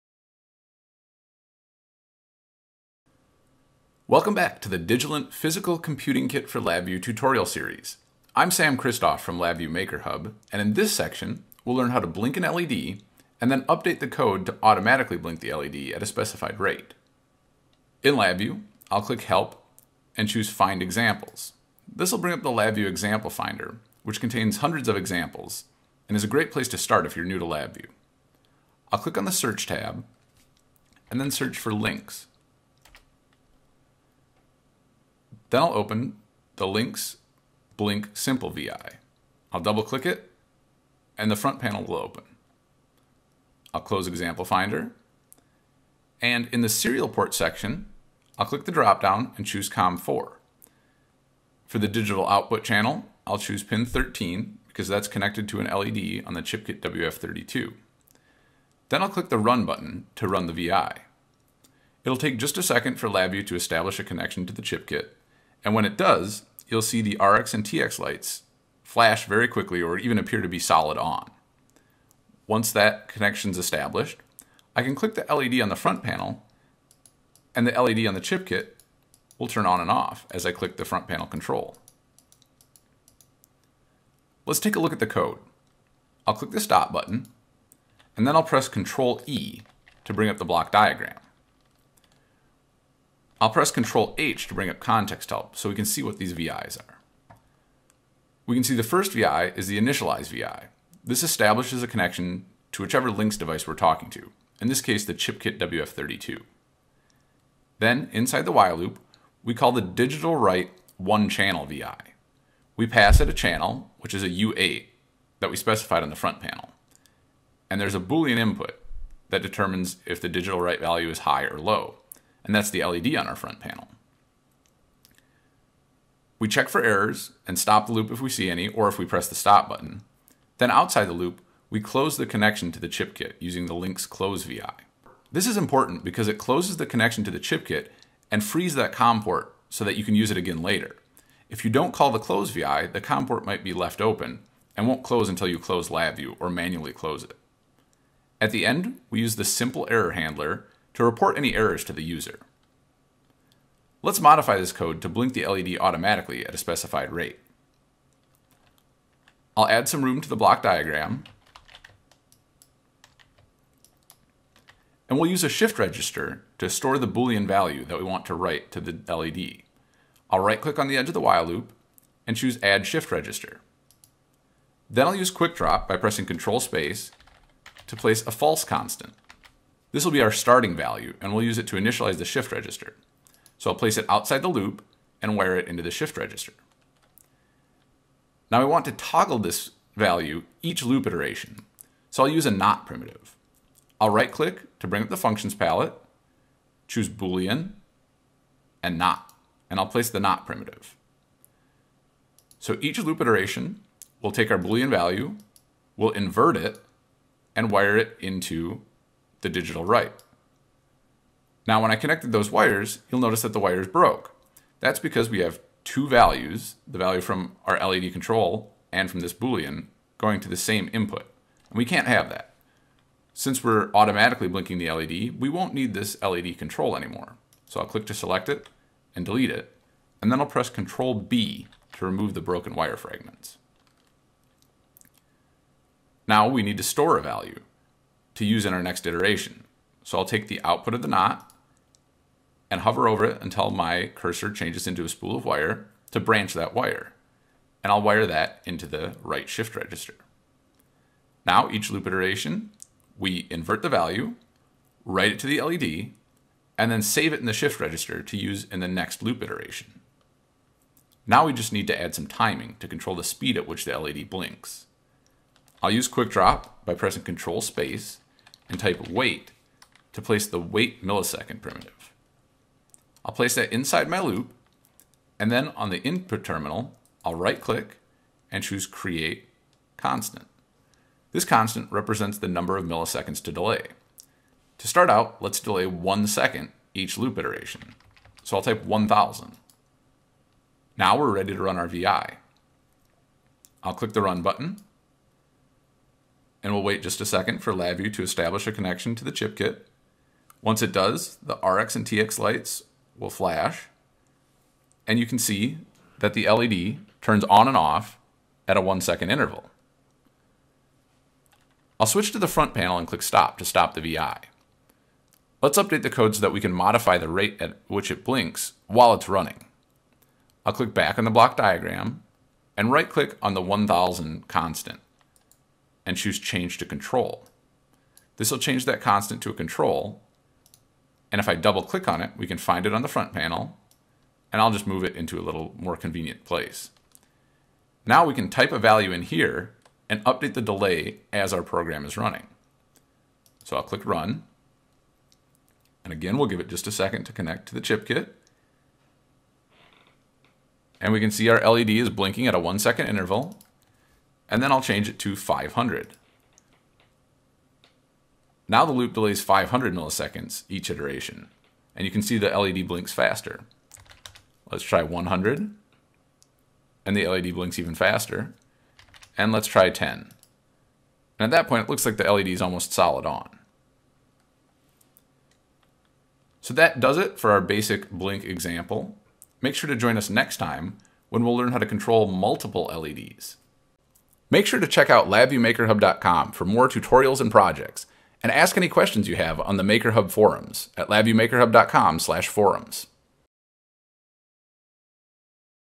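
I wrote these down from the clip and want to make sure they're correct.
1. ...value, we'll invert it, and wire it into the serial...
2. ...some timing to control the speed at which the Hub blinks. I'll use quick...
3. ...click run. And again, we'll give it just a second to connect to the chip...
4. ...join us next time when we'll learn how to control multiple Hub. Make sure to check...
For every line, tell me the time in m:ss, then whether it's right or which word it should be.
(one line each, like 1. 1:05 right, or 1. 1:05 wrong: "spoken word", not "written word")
1. 3:24 wrong: "digital", not "serial"
2. 4:22 wrong: "LED", not "Hub"
3. 5:43 right
4. 6:19 wrong: "LEDs", not "Hub".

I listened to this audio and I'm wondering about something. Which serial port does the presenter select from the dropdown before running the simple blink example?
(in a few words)
COM4.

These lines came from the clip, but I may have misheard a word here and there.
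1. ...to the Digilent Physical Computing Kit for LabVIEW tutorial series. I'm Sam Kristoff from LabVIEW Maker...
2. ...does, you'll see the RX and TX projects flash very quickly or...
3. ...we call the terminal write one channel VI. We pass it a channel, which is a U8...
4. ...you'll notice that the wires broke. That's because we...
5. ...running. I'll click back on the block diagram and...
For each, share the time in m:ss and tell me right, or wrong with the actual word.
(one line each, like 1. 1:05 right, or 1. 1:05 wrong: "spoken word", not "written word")
1. 0:04 right
2. 1:05 wrong: "lights", not "projects"
3. 1:49 wrong: "digital", not "terminal"
4. 3:33 right
5. 5:19 right.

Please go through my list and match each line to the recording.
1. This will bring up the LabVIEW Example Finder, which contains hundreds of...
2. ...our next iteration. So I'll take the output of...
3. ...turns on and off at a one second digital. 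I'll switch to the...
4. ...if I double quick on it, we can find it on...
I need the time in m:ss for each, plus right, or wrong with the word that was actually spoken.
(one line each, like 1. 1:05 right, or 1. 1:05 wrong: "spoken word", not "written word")
1. 0:21 right
2. 3:58 right
3. 5:07 wrong: "interval", not "digital"
4. 5:31 wrong: "click", not "quick".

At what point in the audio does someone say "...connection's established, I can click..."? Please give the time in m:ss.
1:13.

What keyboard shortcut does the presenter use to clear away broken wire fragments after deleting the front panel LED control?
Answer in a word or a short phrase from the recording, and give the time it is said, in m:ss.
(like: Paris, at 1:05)
Control B, at 3:50.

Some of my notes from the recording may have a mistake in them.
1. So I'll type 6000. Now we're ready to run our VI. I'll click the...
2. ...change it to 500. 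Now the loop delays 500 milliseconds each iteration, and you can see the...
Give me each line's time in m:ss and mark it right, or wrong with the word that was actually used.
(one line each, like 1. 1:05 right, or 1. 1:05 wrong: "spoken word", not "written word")
1. 4:48 wrong: "1000", not "6000"
2. 5:54 right.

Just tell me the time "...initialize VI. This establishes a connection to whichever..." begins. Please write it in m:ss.
1:39.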